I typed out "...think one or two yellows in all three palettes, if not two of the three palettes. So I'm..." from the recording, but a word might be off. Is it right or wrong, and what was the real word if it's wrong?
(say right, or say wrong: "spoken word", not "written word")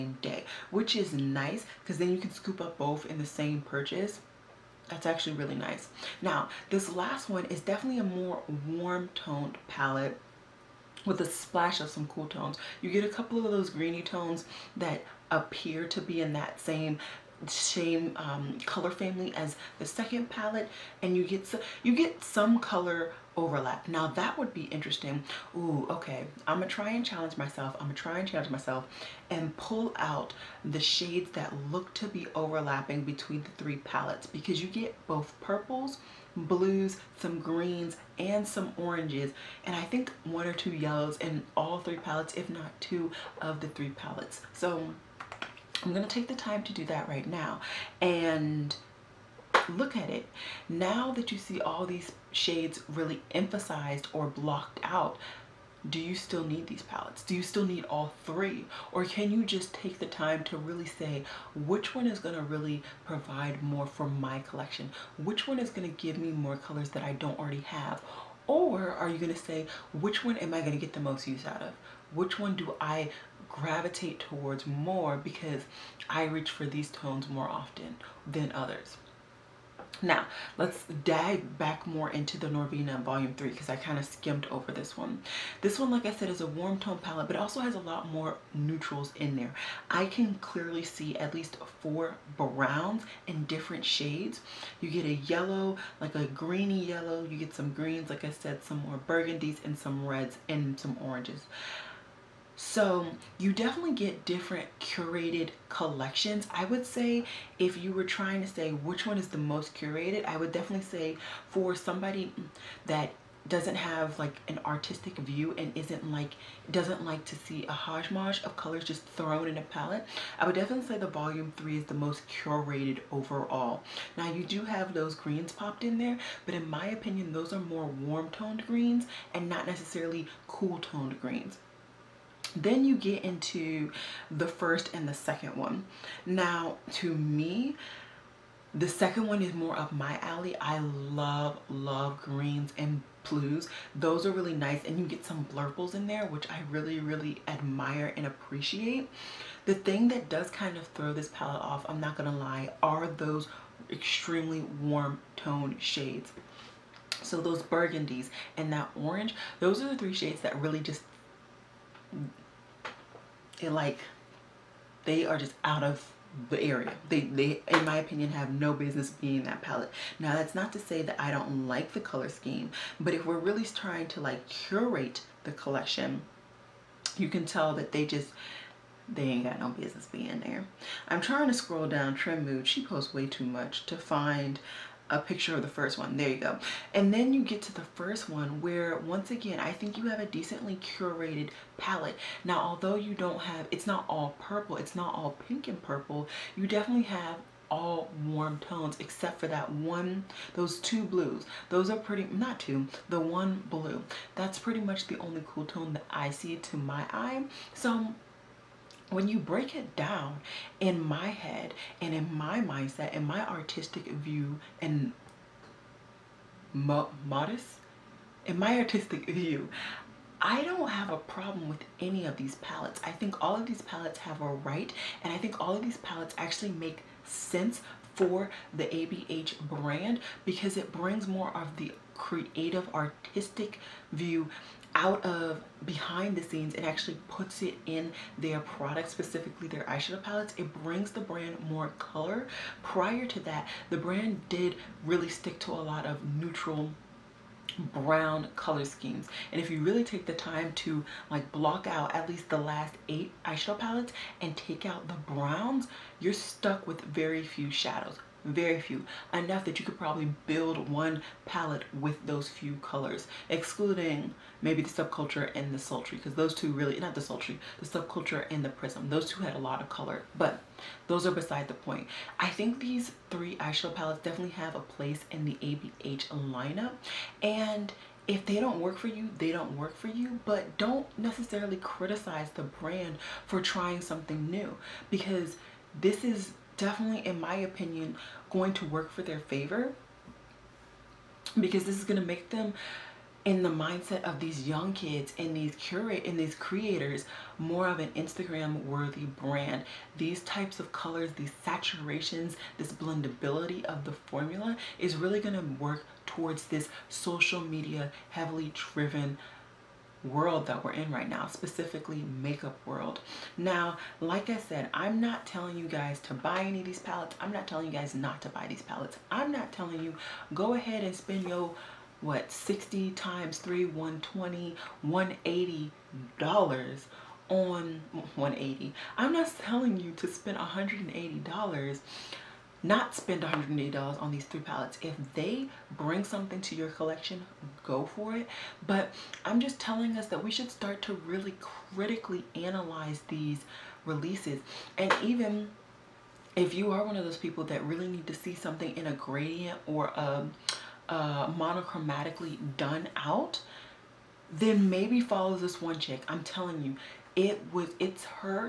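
right.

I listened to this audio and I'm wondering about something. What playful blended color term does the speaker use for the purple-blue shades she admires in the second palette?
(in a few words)
blurples.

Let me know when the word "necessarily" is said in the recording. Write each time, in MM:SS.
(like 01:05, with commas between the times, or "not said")
02:09, 04:41.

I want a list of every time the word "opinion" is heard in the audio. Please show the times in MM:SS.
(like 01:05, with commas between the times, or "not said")
02:06, 02:47, 04:47.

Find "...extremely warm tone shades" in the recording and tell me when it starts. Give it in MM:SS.
02:33.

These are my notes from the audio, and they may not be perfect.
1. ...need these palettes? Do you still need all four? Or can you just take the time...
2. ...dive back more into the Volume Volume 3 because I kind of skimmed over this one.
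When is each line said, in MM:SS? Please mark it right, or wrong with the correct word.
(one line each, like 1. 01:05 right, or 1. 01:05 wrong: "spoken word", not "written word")
1. 00:56 wrong: "three", not "four"
2. 01:21 wrong: "Norvina", not "Volume".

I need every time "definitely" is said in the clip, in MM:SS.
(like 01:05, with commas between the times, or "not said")
00:07, 01:43, 01:50, 02:00, 03:16, 04:34, 04:46.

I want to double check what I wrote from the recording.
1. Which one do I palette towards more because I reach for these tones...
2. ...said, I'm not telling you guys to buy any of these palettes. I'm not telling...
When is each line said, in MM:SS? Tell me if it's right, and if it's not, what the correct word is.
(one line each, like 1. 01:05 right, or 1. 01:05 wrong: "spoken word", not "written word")
1. 01:12 wrong: "gravitate", not "palette"
2. 05:14 right.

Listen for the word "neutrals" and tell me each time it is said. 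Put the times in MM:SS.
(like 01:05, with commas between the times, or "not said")
01:28, 04:06.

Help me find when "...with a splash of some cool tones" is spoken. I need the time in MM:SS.
00:11.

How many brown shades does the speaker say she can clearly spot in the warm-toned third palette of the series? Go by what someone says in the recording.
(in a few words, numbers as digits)
4.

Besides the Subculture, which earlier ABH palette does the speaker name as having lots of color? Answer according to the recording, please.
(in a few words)
Prism.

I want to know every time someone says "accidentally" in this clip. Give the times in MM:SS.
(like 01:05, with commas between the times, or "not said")
not said.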